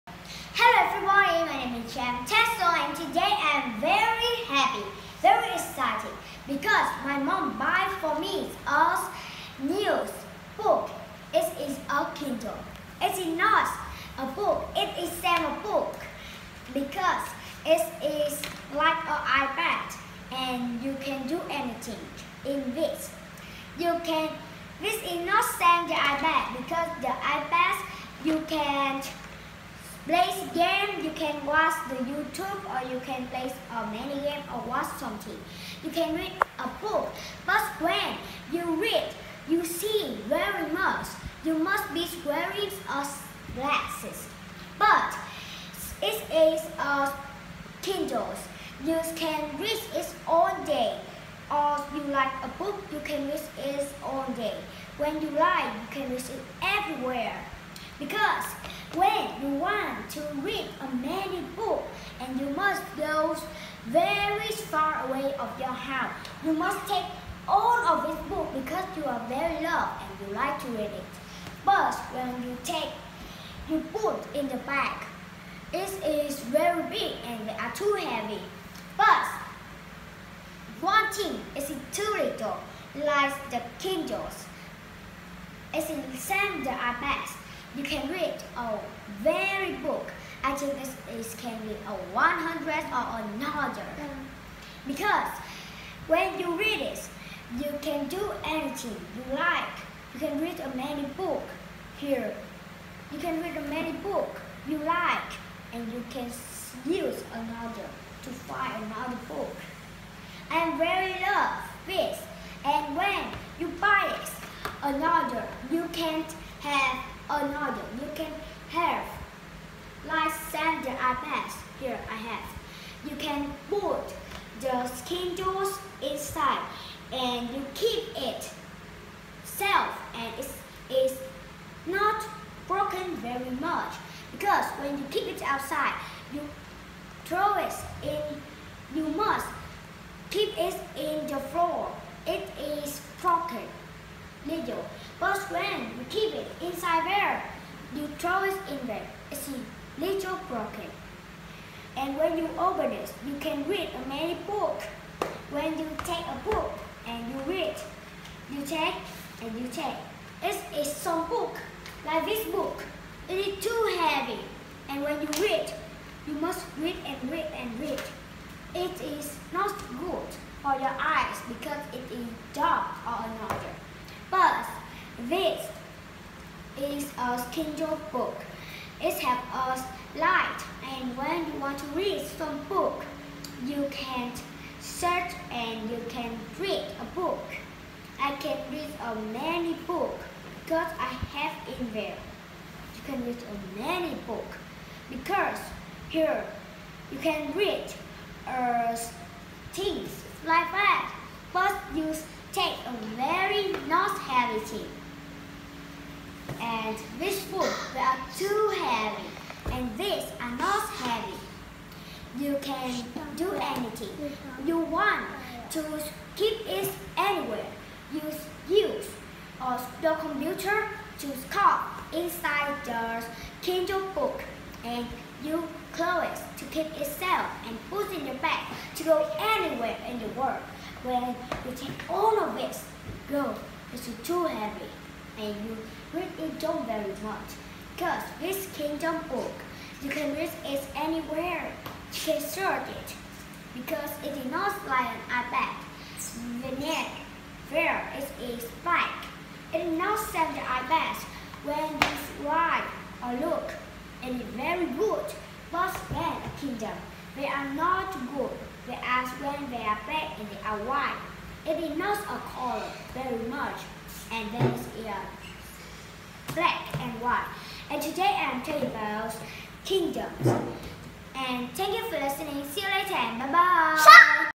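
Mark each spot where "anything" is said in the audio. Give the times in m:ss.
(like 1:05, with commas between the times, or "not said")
0:21, 1:38, 3:33.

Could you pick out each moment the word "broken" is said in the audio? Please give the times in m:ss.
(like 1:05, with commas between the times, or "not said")
2:12, 2:23, 2:30.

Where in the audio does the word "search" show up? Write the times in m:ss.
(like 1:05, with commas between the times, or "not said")
3:04, 4:02.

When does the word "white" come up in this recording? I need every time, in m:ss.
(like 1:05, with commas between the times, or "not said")
4:20, 4:27.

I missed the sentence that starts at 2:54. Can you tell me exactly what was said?
But this is a Kindle book.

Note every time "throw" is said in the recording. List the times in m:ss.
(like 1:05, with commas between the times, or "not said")
2:17, 2:28.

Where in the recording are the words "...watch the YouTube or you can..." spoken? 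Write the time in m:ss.
0:31.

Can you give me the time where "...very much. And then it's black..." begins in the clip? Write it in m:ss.
4:23.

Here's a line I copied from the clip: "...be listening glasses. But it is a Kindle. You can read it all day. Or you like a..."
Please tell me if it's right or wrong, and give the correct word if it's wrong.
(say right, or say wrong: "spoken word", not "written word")
wrong: "wearing", not "listening".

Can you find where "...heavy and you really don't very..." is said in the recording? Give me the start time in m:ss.
3:54.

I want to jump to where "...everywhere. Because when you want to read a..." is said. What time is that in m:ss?
0:56.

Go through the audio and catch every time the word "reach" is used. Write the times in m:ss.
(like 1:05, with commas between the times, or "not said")
4:00.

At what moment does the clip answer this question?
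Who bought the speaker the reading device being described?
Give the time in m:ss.
0:07.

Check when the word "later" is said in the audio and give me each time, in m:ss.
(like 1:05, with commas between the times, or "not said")
4:32.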